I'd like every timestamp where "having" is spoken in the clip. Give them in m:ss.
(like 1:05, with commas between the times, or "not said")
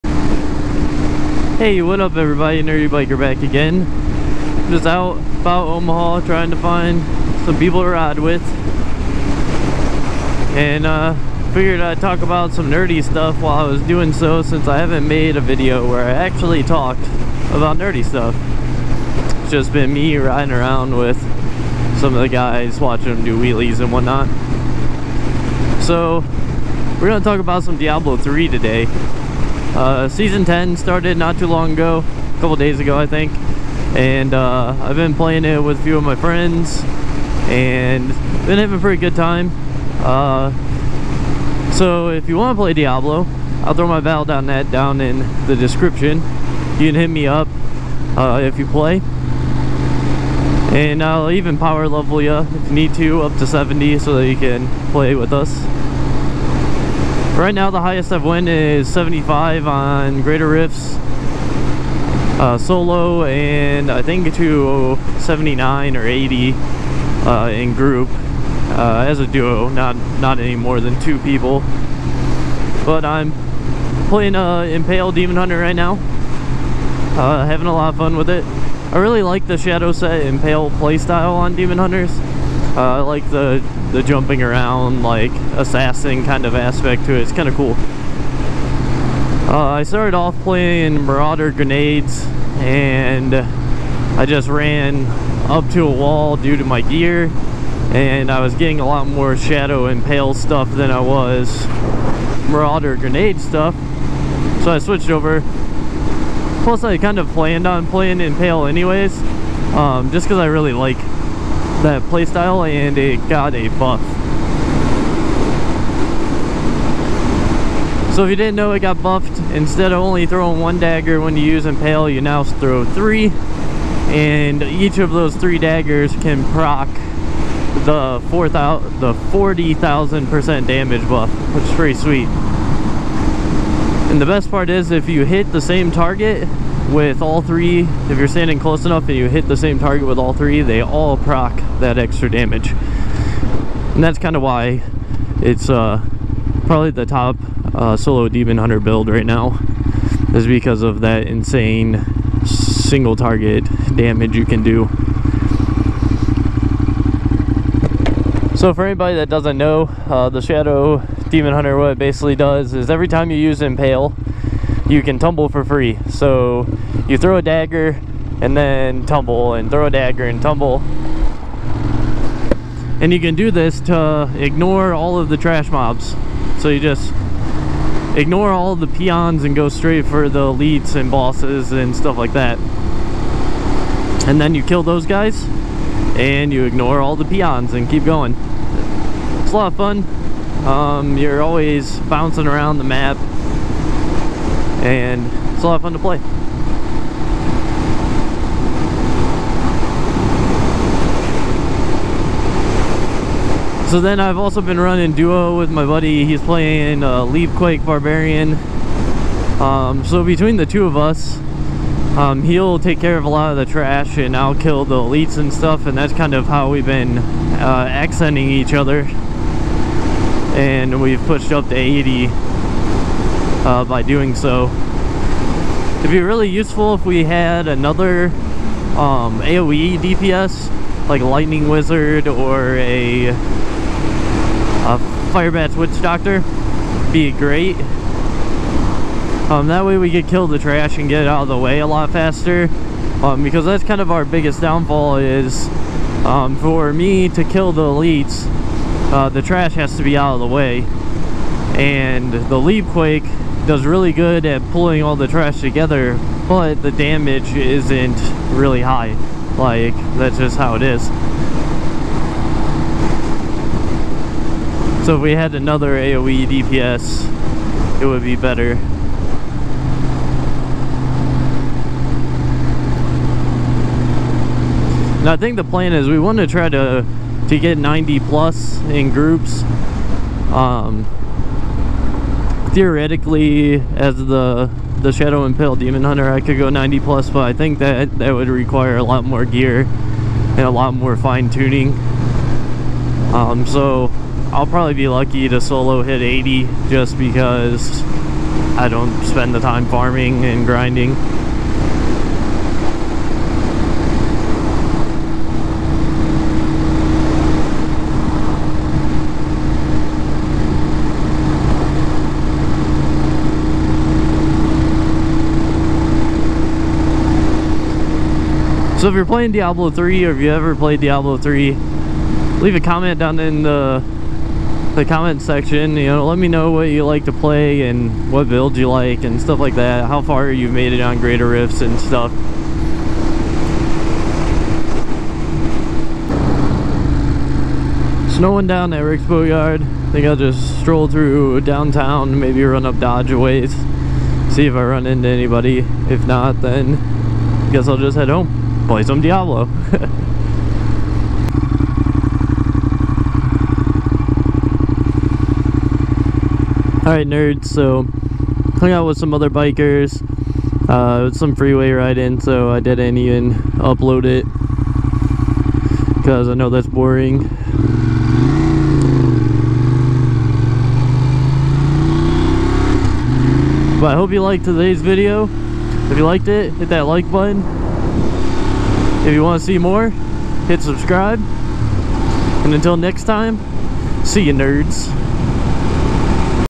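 0:38, 1:17.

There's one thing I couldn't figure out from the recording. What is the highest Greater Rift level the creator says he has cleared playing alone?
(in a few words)
75.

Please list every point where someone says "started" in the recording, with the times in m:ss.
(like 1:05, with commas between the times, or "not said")
0:30, 1:29.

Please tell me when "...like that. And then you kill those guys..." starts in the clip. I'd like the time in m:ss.
3:02.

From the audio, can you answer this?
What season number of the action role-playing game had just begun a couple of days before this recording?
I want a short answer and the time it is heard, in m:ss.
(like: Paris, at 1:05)
10, at 0:30.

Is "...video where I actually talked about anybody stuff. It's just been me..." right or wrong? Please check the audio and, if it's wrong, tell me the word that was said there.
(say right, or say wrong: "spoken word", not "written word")
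wrong: "nerdy", not "anybody".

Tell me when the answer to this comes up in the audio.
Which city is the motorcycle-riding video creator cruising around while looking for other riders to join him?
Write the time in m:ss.
0:05.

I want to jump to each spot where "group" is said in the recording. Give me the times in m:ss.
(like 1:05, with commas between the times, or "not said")
1:07, 4:39.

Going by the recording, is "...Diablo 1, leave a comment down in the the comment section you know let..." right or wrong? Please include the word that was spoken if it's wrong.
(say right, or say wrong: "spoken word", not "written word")
wrong: "3", not "1".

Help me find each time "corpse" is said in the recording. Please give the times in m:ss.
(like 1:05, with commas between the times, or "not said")
not said.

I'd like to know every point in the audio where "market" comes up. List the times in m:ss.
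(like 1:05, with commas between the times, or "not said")
not said.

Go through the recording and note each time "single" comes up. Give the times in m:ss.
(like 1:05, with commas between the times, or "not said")
2:32.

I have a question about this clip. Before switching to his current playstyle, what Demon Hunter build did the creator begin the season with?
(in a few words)
Marauder Grenades.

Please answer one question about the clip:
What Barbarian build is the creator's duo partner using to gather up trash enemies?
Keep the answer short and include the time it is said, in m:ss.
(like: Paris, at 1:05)
Leapquake Barbarian, at 3:27.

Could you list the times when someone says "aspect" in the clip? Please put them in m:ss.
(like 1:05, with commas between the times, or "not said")
1:26.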